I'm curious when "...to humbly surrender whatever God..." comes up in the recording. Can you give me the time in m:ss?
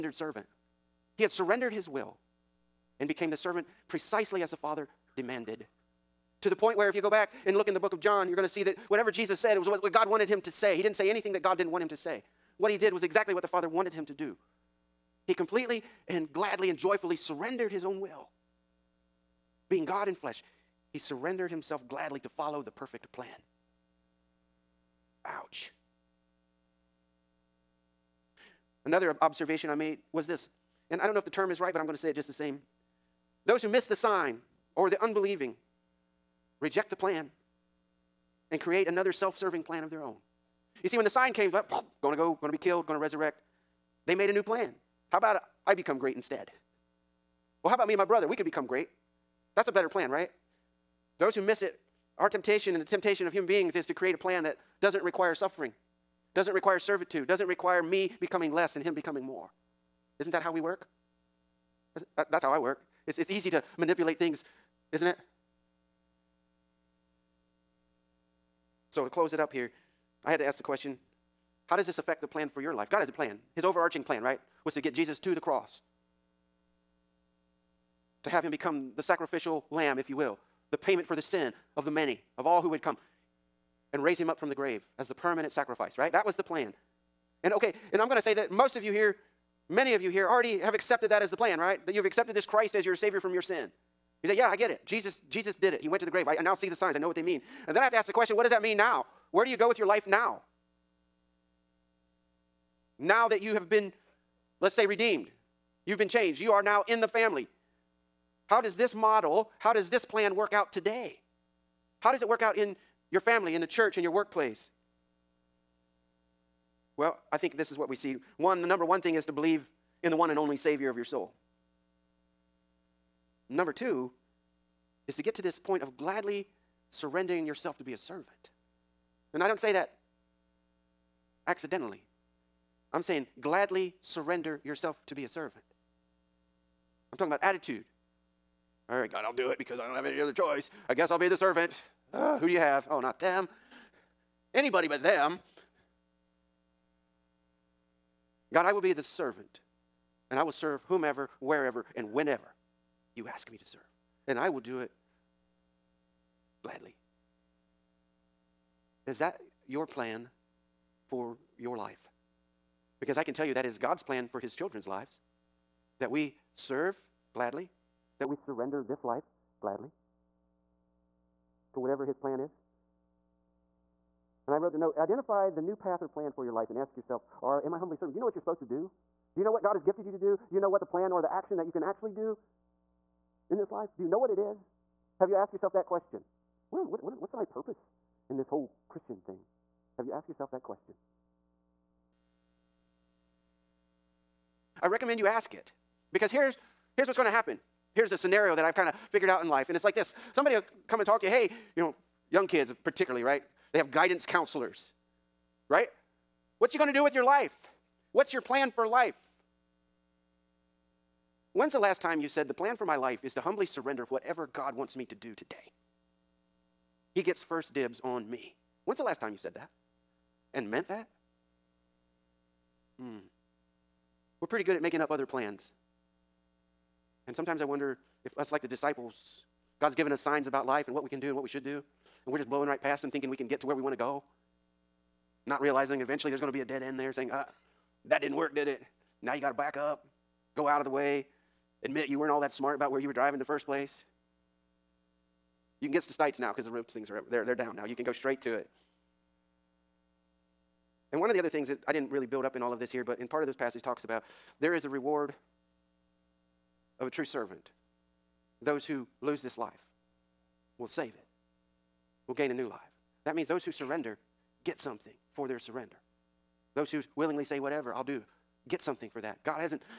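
3:33.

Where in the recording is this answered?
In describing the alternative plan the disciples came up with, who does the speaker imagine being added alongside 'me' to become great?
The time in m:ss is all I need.
0:47.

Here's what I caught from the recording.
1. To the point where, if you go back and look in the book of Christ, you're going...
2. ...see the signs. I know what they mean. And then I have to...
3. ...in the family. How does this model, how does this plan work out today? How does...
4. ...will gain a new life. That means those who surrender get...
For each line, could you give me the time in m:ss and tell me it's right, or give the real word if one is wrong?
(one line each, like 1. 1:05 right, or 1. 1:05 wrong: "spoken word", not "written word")
1. 0:06 wrong: "John", not "Christ"
2. 1:36 right
3. 1:46 right
4. 4:22 right.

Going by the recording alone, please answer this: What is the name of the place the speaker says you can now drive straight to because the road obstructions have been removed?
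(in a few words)
Stites.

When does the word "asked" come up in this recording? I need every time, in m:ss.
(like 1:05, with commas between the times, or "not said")
3:05, 3:10.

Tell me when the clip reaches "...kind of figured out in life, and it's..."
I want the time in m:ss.
3:18.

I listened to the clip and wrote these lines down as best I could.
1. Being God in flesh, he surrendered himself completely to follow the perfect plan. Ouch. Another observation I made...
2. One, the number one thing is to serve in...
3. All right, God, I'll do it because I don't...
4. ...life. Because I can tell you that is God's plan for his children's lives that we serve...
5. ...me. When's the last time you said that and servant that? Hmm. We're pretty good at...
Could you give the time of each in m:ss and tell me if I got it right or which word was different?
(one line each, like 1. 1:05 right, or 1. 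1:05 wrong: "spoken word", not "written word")
1. 0:19 wrong: "gladly", not "completely"
2. 1:58 wrong: "believe", not "serve"
3. 2:18 right
4. 2:41 right
5. 3:38 wrong: "meant", not "servant".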